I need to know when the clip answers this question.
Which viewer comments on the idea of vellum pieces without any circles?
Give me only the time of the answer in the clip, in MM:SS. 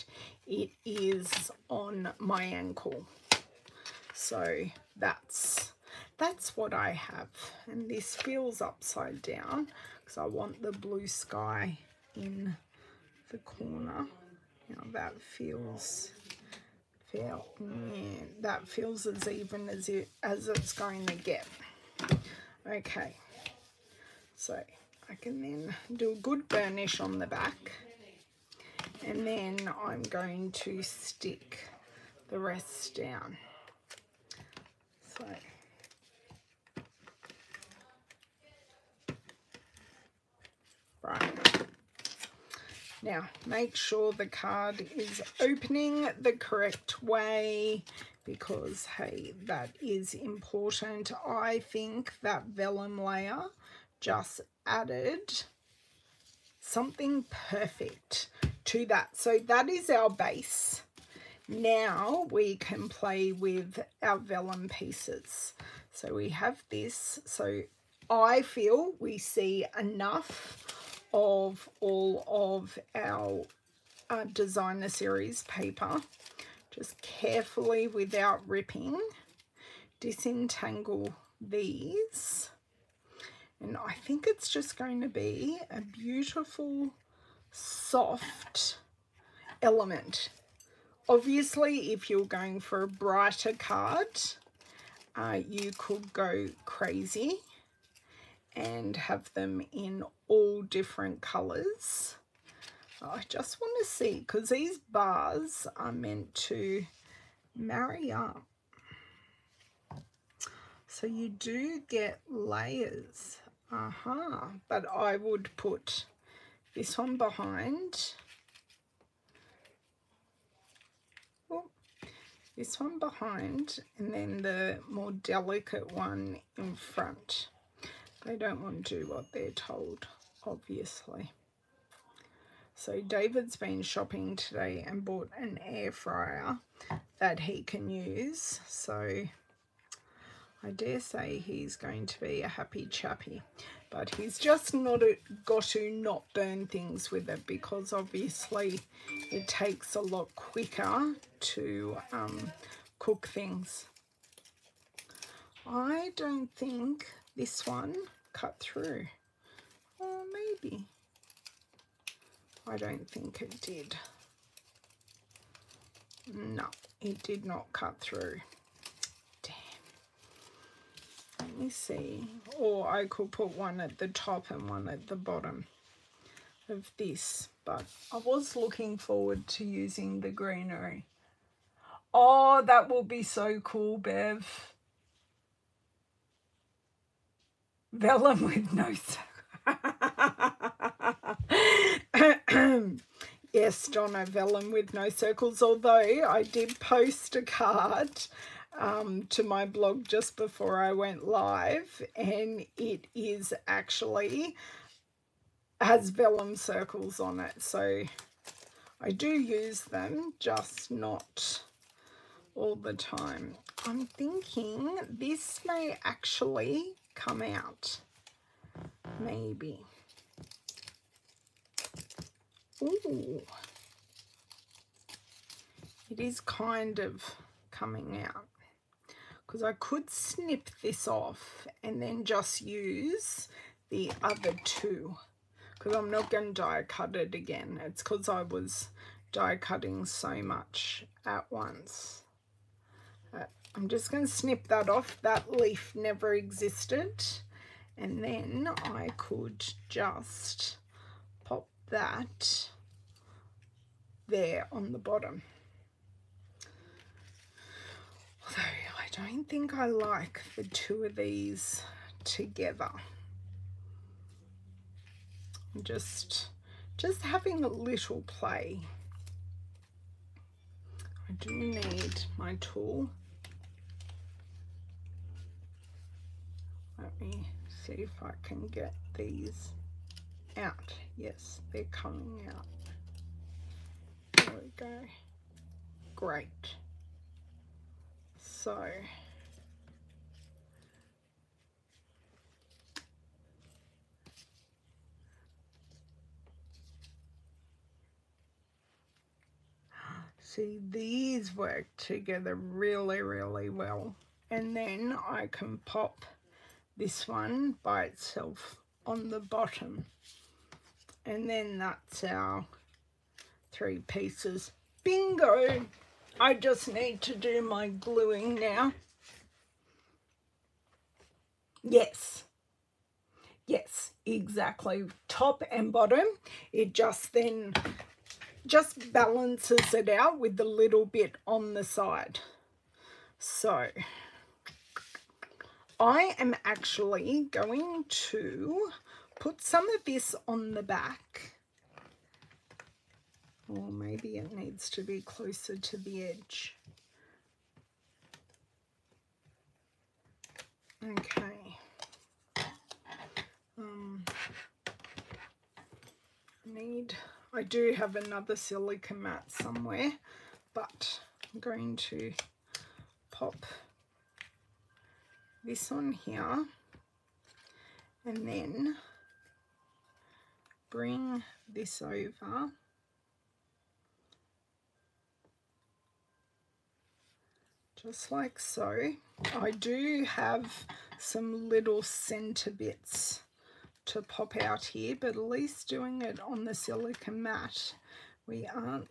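03:13.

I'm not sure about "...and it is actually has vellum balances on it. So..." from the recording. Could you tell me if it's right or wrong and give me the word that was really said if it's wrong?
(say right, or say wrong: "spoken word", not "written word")
wrong: "circles", not "balances".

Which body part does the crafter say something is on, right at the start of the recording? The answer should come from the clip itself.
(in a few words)
Ankle.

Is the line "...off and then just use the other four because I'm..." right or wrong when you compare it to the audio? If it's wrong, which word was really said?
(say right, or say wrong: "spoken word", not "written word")
wrong: "two", not "four".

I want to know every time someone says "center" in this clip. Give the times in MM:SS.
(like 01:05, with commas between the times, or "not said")
06:22.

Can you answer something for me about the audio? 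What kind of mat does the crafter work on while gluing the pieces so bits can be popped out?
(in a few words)
Silicone mat.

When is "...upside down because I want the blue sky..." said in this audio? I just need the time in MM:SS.
00:08.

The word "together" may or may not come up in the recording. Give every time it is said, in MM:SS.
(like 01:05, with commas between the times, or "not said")
04:22, 05:01.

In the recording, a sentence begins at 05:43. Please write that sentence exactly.
Or maybe it needs to be closer to the edge.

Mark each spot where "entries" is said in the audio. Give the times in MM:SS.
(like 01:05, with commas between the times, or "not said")
not said.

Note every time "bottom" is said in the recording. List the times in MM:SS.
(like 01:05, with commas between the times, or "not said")
02:55, 04:14, 05:09, 05:25.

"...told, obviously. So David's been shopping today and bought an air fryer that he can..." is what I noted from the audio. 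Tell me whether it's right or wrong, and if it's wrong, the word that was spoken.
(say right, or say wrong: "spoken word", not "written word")
right.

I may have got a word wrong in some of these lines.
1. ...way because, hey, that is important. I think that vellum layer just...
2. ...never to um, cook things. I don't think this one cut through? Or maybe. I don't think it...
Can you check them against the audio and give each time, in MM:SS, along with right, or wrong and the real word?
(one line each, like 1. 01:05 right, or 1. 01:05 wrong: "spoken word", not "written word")
1. 00:47 right
2. 02:30 wrong: "quicker", not "never".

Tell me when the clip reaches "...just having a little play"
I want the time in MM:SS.
04:26.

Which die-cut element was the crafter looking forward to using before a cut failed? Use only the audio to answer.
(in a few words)
The greenery.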